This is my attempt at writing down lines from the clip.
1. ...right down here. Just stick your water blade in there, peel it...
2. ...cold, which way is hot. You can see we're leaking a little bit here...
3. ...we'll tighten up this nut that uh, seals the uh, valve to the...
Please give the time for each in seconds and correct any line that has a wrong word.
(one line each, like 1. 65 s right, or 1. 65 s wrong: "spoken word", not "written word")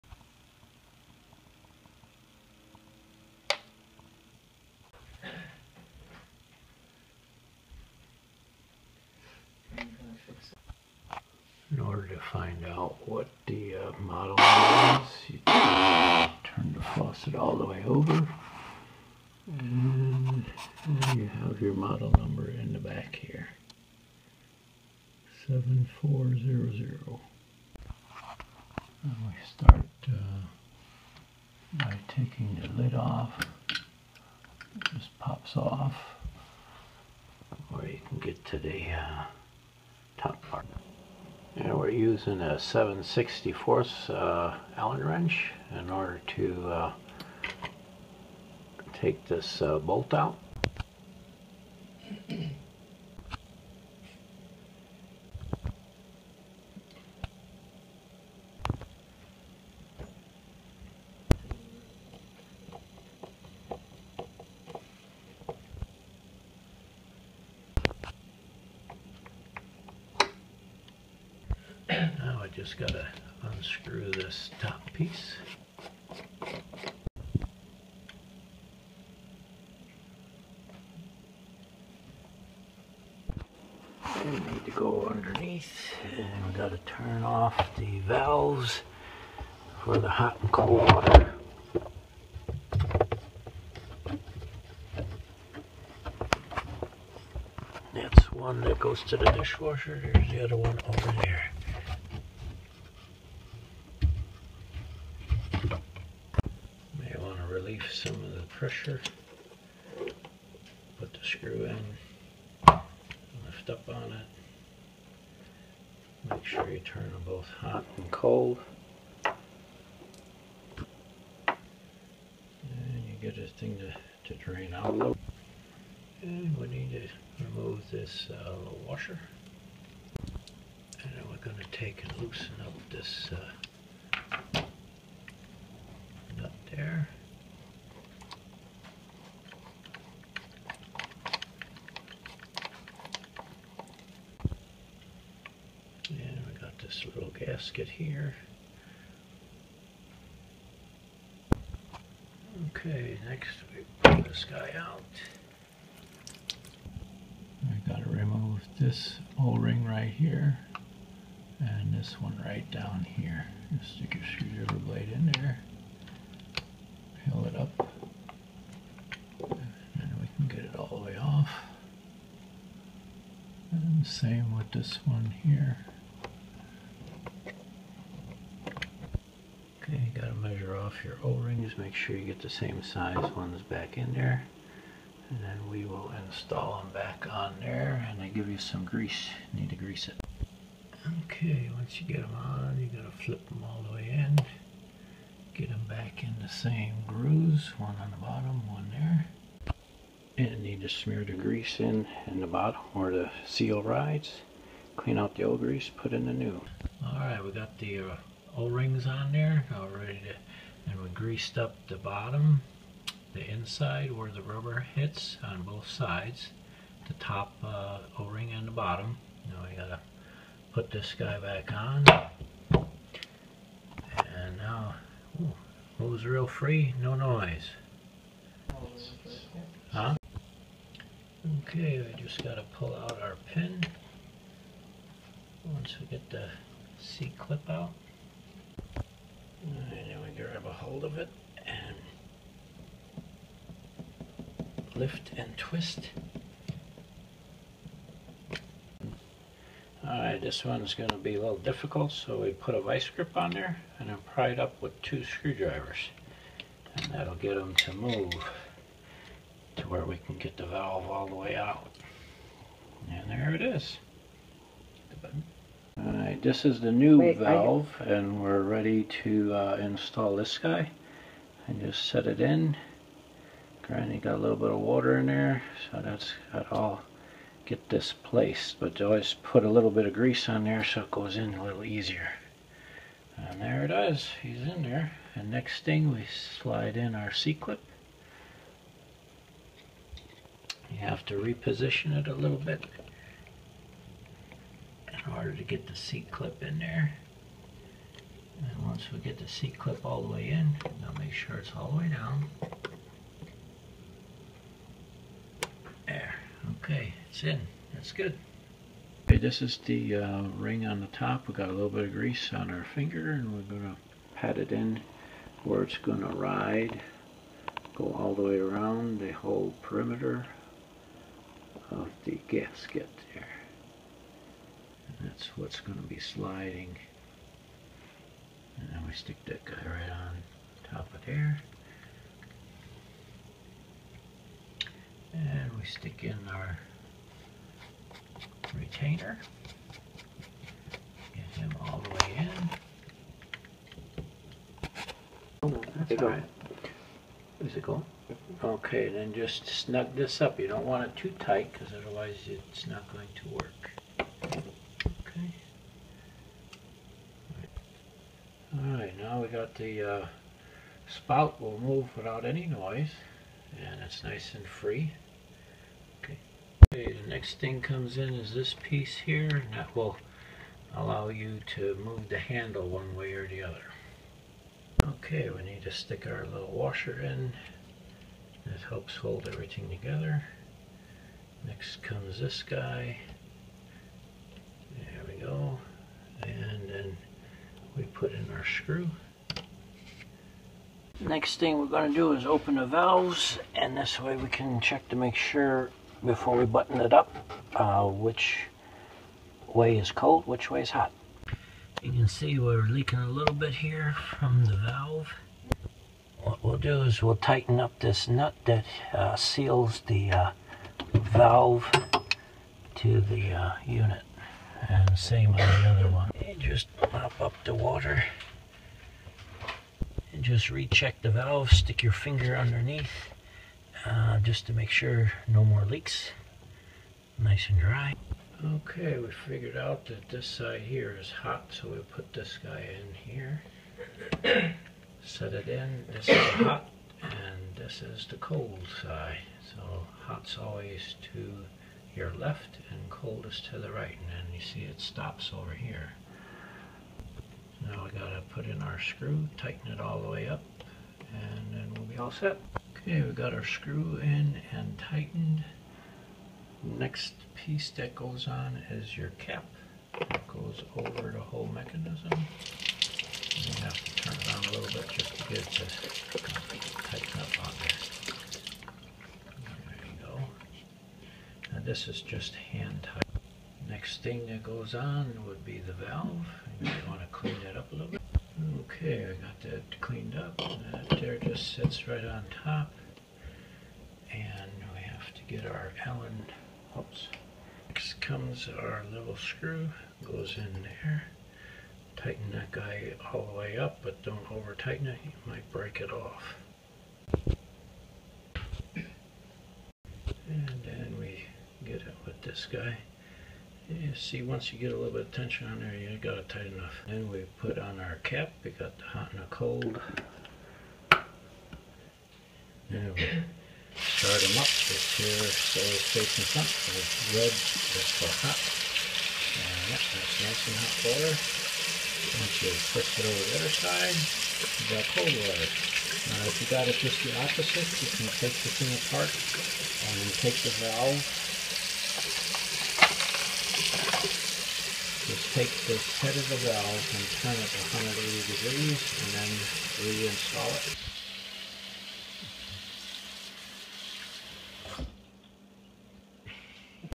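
1. 162 s wrong: "screwdriver", not "water"
2. 400 s right
3. 407 s right.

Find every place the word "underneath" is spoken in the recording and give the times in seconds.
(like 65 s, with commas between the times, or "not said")
85 s, 422 s.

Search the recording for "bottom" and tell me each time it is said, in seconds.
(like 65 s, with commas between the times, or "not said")
198 s, 202 s, 211 s, 218 s.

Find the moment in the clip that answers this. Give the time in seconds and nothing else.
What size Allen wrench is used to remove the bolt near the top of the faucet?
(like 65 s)
42 s.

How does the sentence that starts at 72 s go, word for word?
just gotta unscrew this top piece.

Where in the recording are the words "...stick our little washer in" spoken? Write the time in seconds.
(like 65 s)
375 s.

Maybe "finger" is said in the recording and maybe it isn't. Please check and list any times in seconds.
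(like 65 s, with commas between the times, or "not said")
312 s, 422 s.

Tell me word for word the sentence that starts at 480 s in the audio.
That there just sits right on top.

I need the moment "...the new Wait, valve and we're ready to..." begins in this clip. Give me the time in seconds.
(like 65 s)
266 s.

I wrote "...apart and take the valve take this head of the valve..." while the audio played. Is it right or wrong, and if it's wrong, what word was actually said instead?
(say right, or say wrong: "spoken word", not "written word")
right.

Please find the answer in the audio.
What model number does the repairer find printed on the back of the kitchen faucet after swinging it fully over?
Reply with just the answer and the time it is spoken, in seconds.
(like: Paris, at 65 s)
7400, at 25 s.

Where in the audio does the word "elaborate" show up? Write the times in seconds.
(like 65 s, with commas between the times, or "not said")
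not said.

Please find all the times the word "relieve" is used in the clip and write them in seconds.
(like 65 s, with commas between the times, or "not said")
107 s.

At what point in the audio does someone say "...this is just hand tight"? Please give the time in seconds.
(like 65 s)
471 s.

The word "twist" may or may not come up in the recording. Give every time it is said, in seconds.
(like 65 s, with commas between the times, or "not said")
245 s, 522 s.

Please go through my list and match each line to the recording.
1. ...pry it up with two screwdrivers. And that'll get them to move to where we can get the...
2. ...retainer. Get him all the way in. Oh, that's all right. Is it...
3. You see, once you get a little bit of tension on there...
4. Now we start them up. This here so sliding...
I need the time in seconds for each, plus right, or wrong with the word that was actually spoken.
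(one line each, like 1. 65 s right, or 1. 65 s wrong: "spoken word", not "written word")
1. 254 s right
2. 338 s right
3. 503 s right
4. 512 s wrong: "facing", not "sliding".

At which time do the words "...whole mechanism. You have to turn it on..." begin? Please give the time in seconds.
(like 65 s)
461 s.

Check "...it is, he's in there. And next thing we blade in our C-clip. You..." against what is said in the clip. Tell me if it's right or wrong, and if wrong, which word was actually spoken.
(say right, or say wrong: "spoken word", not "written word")
wrong: "slide", not "blade".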